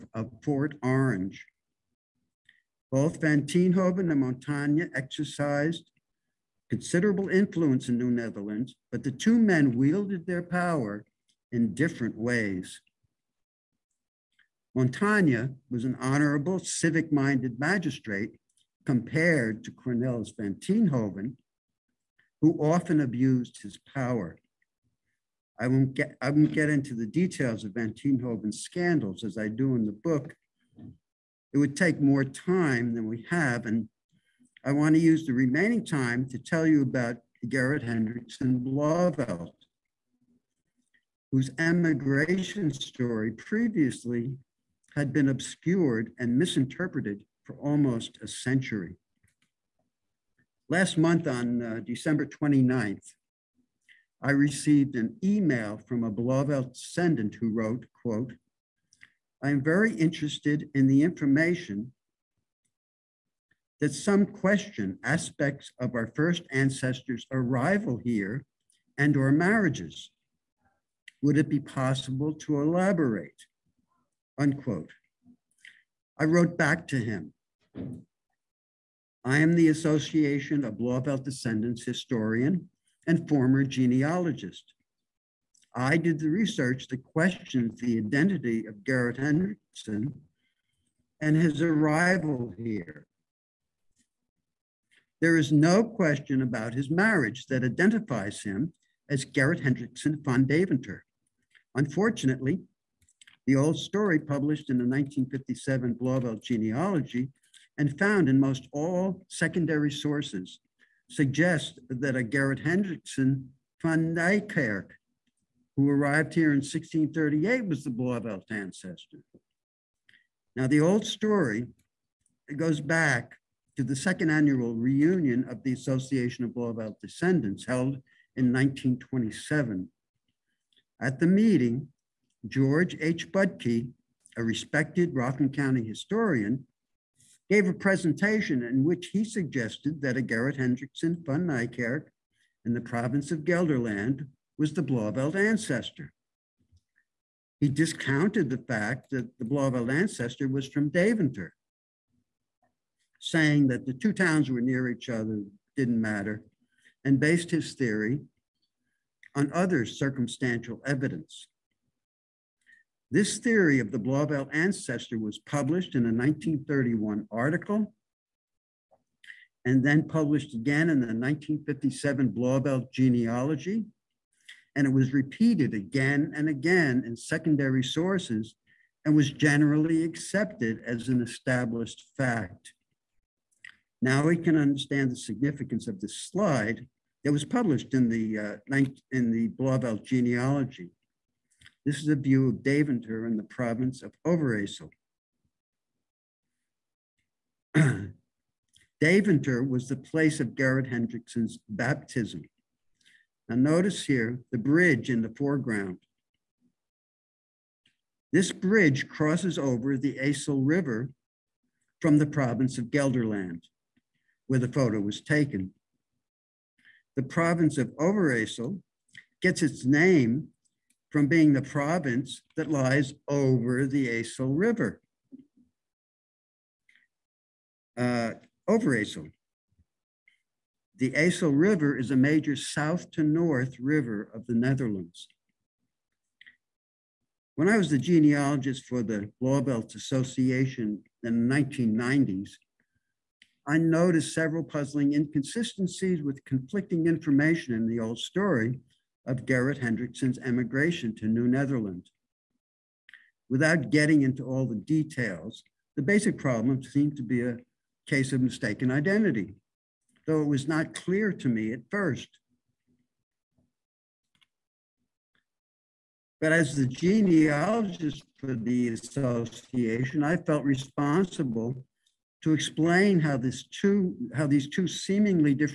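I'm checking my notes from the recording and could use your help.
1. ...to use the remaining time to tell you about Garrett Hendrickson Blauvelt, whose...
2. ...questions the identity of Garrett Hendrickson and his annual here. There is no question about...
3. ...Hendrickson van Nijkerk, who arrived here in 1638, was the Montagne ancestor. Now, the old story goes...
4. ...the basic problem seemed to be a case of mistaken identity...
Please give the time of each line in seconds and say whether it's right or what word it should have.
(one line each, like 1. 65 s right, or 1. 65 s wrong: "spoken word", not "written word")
1. 34 s right
2. 87 s wrong: "arrival", not "annual"
3. 112 s wrong: "Blauvelt", not "Montagne"
4. 255 s right.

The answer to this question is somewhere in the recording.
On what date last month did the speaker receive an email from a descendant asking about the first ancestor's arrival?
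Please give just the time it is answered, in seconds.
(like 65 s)
51 s.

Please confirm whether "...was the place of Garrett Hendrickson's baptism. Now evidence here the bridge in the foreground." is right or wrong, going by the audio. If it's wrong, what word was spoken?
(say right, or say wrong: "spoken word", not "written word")
wrong: "notice", not "evidence".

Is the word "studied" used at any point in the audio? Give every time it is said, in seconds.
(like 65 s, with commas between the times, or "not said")
not said.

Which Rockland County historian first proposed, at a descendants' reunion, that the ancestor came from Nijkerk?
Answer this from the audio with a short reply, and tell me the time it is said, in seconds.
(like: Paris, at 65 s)
George H. Budke, at 132 s.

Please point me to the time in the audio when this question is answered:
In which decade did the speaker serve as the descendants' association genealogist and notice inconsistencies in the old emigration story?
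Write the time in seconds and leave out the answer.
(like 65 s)
241 s.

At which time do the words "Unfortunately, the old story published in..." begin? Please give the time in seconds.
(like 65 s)
101 s.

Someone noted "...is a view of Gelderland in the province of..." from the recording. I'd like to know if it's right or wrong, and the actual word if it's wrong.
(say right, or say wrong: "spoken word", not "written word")
wrong: "Daventer", not "Gelderland".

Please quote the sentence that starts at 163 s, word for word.
This theory of the Blauvelt ancestor was published in a 1931 article and then published again in the 1957 Blauvelt genealogy.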